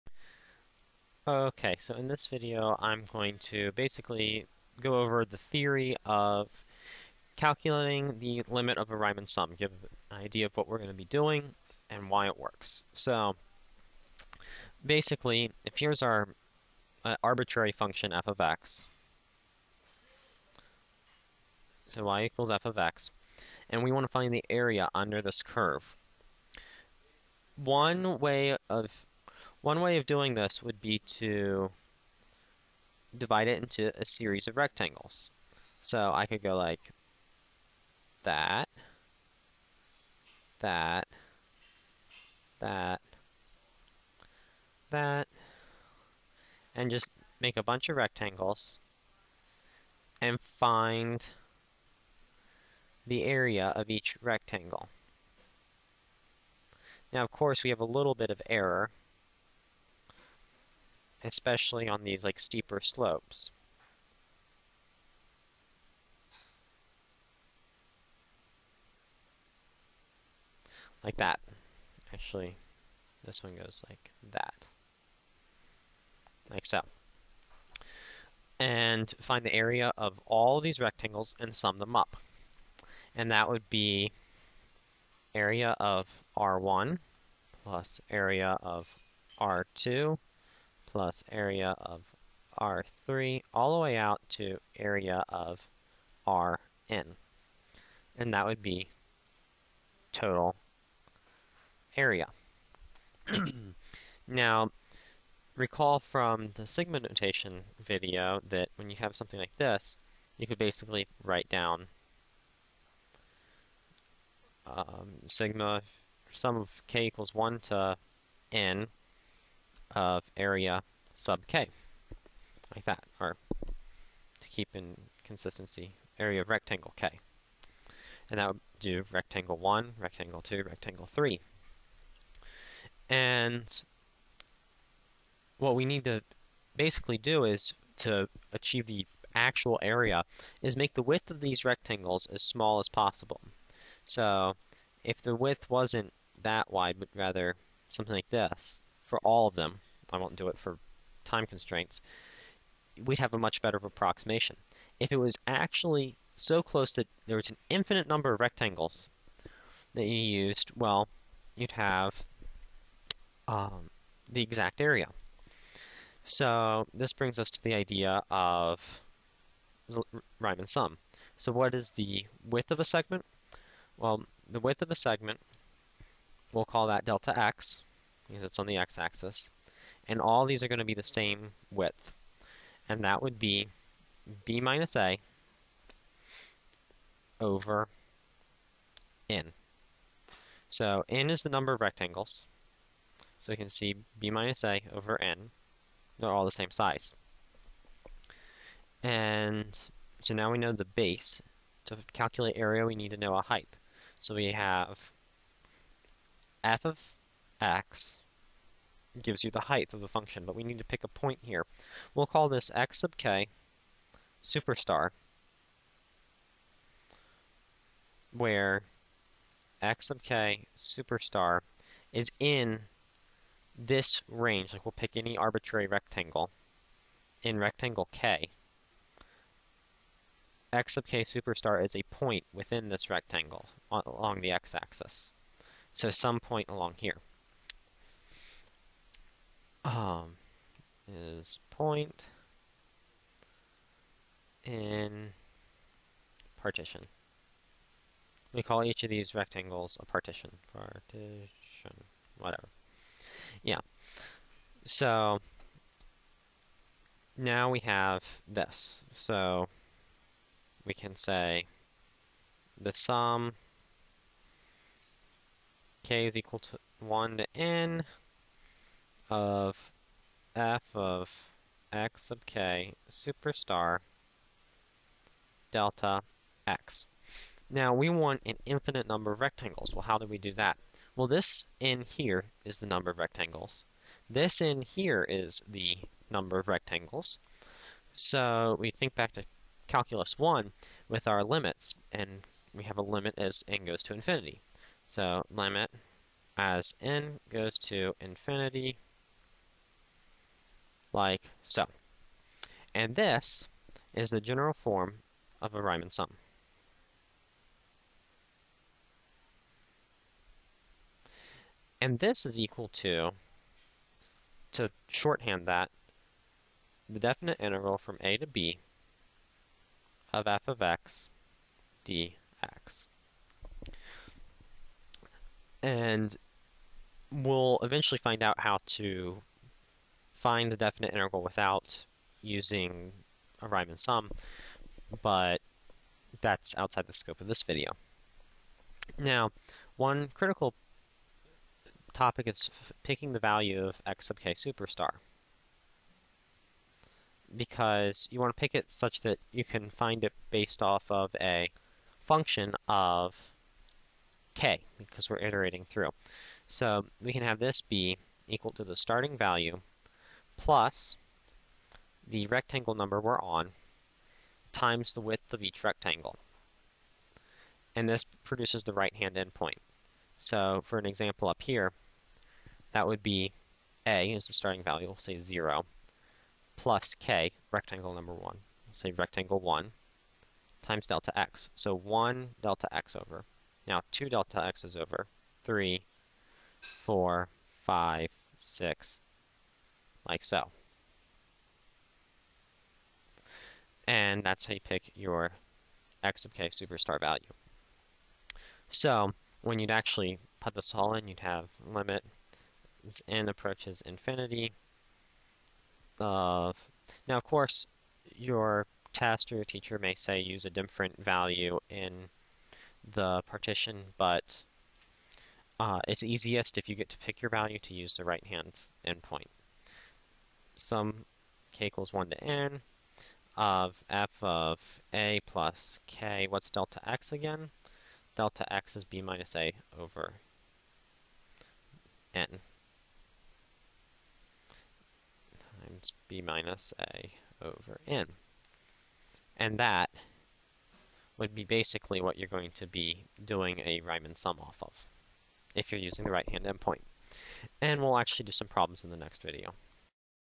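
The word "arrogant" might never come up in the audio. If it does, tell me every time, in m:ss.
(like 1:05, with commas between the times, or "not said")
not said.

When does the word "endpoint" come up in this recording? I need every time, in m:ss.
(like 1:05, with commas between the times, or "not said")
6:09, 6:59, 7:26.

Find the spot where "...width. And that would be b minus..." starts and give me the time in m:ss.
3:01.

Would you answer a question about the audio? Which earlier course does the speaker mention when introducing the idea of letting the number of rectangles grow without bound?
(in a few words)
calculus 1.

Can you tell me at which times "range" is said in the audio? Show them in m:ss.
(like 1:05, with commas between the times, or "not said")
3:44.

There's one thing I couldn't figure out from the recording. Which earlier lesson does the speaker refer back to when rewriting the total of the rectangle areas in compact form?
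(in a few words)
sigma notation video.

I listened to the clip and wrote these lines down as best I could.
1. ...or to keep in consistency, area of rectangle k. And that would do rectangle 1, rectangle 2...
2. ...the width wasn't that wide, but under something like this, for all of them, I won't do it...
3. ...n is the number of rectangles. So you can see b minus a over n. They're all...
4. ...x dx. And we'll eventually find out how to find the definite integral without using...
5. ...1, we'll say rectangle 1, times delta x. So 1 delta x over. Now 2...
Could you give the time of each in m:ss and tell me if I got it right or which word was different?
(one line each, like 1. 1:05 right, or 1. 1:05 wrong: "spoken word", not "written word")
1. 2:03 right
2. 2:25 wrong: "rather", not "under"
3. 3:11 right
4. 5:20 right
5. 6:18 right.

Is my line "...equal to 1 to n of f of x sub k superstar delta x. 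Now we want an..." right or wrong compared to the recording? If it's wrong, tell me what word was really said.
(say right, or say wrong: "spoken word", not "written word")
right.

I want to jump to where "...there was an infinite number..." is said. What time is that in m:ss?
2:37.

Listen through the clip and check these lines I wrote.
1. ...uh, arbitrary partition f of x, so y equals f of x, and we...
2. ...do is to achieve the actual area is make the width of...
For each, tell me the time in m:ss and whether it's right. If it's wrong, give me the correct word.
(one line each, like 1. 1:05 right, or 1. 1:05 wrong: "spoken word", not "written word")
1. 0:17 wrong: "function", not "partition"
2. 2:17 right.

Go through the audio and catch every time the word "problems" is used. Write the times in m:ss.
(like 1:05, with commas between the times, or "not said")
7:28.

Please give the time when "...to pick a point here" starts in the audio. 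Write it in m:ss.
3:30.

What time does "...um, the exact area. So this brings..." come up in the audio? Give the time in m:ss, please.
2:43.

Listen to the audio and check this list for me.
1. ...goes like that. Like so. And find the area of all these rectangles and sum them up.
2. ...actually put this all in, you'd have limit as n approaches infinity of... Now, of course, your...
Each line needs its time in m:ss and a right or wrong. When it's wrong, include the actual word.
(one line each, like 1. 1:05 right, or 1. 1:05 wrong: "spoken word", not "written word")
1. 1:13 right
2. 6:39 right.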